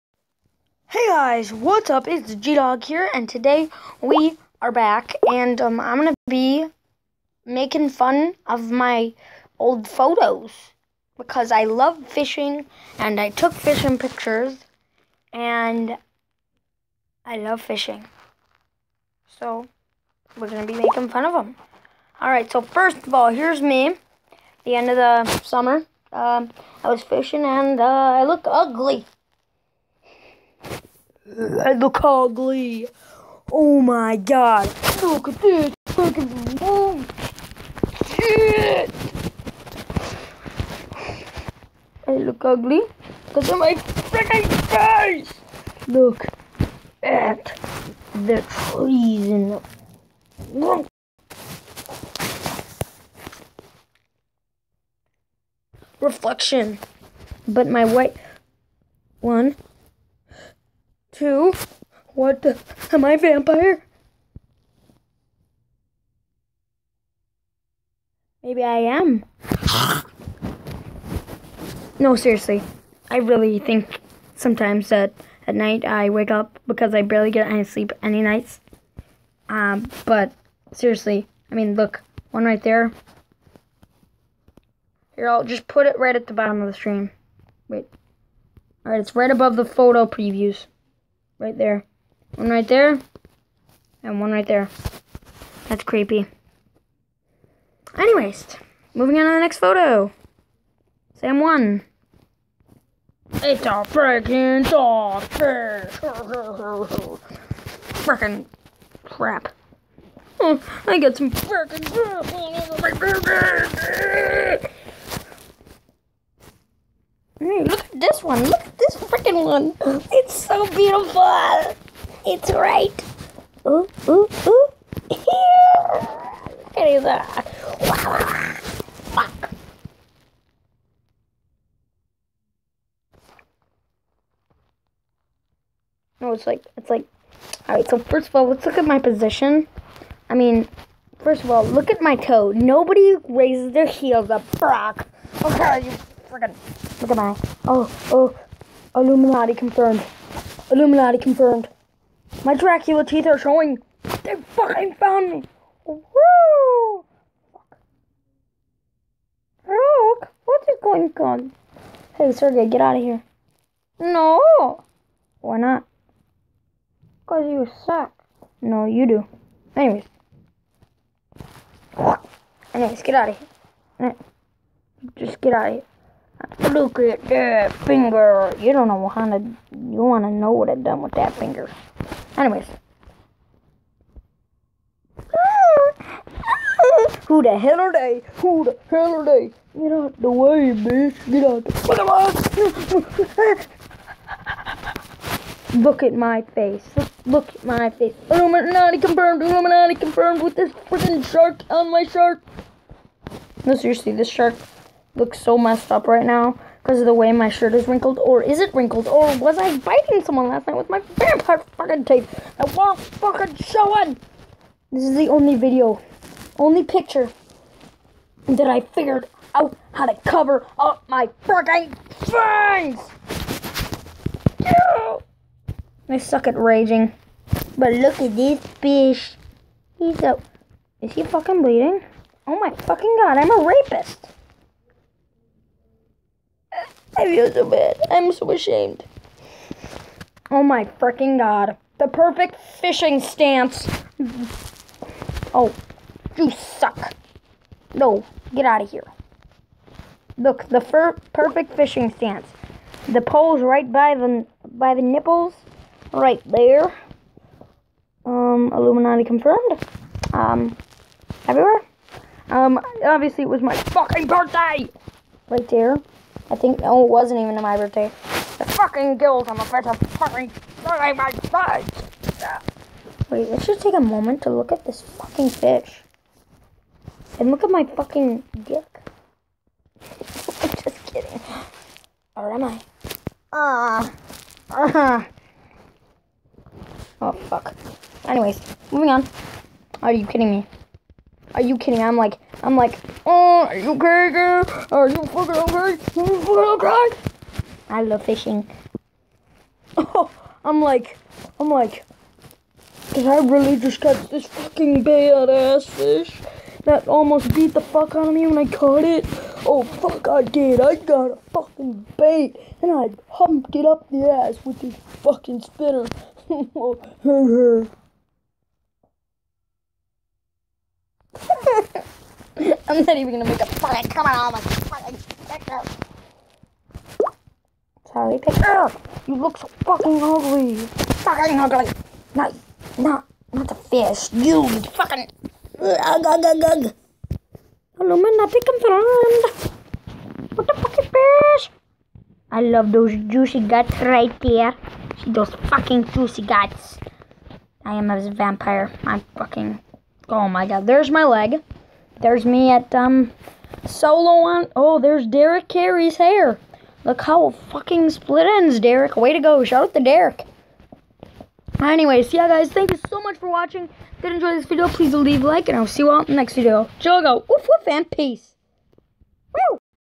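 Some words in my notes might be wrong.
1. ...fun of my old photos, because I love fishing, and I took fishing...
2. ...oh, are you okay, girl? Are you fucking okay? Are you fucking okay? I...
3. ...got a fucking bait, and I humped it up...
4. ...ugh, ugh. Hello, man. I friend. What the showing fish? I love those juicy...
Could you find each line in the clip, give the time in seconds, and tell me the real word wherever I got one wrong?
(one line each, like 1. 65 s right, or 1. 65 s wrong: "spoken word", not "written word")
1. 7 s right
2. 293 s right
3. 310 s right
4. 336 s wrong: "fucking", not "showing".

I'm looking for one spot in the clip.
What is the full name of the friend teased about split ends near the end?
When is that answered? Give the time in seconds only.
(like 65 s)
355 s.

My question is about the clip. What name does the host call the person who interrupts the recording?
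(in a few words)
Sergey.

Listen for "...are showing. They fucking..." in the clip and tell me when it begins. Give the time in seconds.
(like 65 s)
153 s.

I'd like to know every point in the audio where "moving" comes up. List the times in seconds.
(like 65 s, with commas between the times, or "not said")
98 s, 288 s.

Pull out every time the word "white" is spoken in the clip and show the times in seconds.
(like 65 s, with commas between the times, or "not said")
57 s.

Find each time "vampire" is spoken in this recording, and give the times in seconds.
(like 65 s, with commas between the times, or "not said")
63 s, 211 s, 348 s.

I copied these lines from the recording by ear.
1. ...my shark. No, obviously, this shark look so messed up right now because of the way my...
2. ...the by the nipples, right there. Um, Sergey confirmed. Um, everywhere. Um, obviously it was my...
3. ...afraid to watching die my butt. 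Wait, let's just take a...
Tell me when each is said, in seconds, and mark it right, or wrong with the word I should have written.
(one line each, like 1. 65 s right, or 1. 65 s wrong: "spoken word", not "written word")
1. 201 s wrong: "seriously", not "obviously"
2. 254 s wrong: "Illuminati", not "Sergey"
3. 269 s wrong: "fucking", not "watching".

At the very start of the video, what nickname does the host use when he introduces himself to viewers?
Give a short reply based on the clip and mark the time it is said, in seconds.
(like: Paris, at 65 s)
G-Dog, at 2 s.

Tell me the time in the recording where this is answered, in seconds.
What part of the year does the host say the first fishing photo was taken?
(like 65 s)
24 s.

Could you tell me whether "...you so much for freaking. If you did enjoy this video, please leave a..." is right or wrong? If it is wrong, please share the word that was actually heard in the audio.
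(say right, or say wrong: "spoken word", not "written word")
wrong: "watching", not "freaking".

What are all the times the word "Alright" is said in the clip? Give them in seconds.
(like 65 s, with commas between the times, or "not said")
22 s, 88 s.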